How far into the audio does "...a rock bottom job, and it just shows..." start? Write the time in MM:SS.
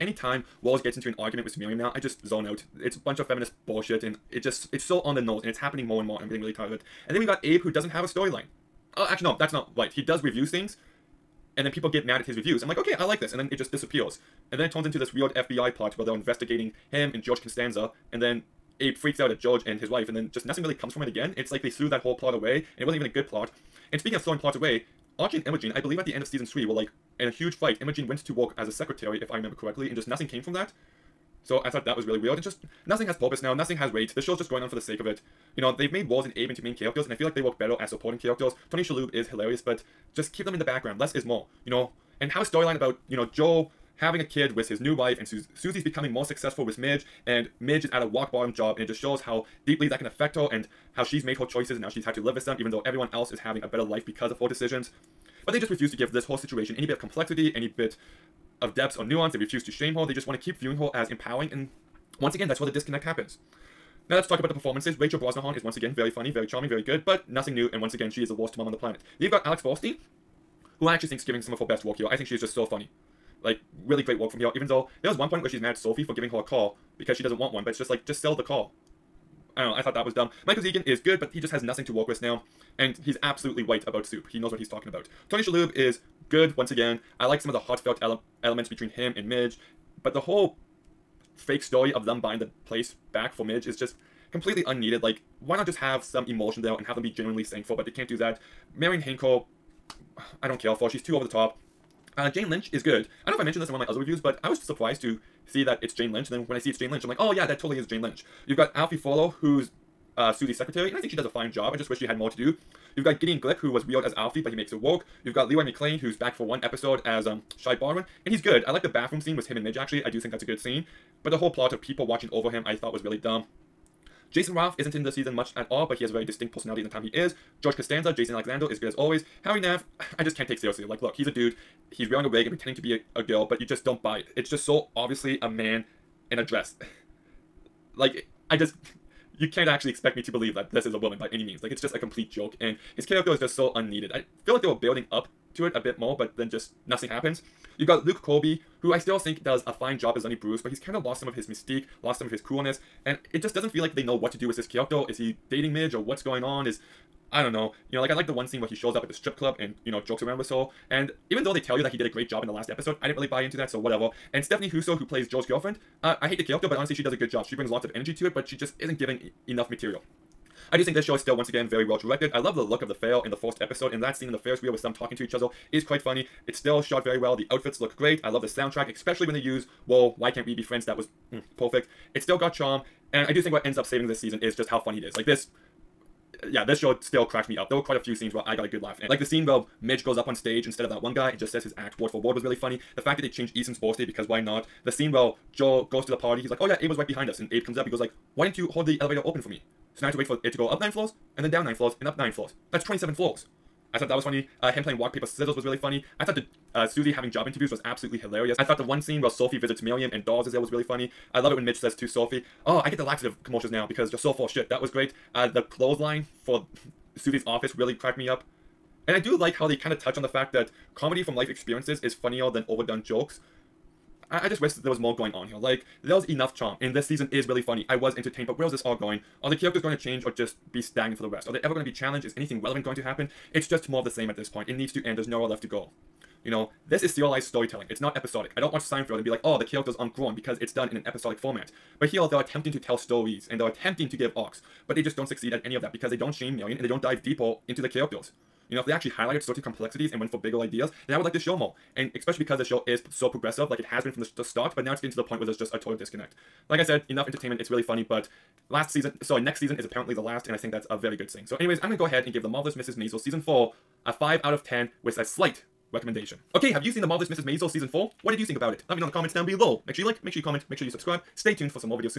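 00:48.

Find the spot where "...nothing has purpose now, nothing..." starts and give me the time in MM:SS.
00:32.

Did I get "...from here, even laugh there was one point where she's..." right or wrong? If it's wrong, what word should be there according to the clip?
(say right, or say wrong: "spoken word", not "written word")
wrong: "though", not "laugh".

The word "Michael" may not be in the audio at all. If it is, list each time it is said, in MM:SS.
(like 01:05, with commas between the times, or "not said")
01:20.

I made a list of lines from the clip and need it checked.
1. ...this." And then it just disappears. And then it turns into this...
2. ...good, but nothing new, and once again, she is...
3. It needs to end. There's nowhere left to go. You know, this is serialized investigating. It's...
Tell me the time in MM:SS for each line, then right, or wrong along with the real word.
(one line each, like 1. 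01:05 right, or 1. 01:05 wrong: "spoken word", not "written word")
1. 00:13 right
2. 01:06 right
3. 03:54 wrong: "storytelling", not "investigating".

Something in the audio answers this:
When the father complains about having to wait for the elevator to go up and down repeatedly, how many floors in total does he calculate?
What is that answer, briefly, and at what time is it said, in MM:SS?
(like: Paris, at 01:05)
27, at 03:22.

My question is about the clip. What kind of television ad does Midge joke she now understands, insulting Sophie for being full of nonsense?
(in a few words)
Laxative commercials.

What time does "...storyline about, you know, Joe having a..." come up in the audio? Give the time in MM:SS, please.
00:42.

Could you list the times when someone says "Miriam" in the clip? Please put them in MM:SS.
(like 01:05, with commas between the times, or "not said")
00:01, 03:29.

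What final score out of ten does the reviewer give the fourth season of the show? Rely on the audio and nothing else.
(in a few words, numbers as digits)
5.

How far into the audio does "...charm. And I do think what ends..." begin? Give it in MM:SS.
03:02.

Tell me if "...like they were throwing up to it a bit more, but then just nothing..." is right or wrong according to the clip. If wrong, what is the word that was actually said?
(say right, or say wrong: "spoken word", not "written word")
wrong: "building", not "throwing".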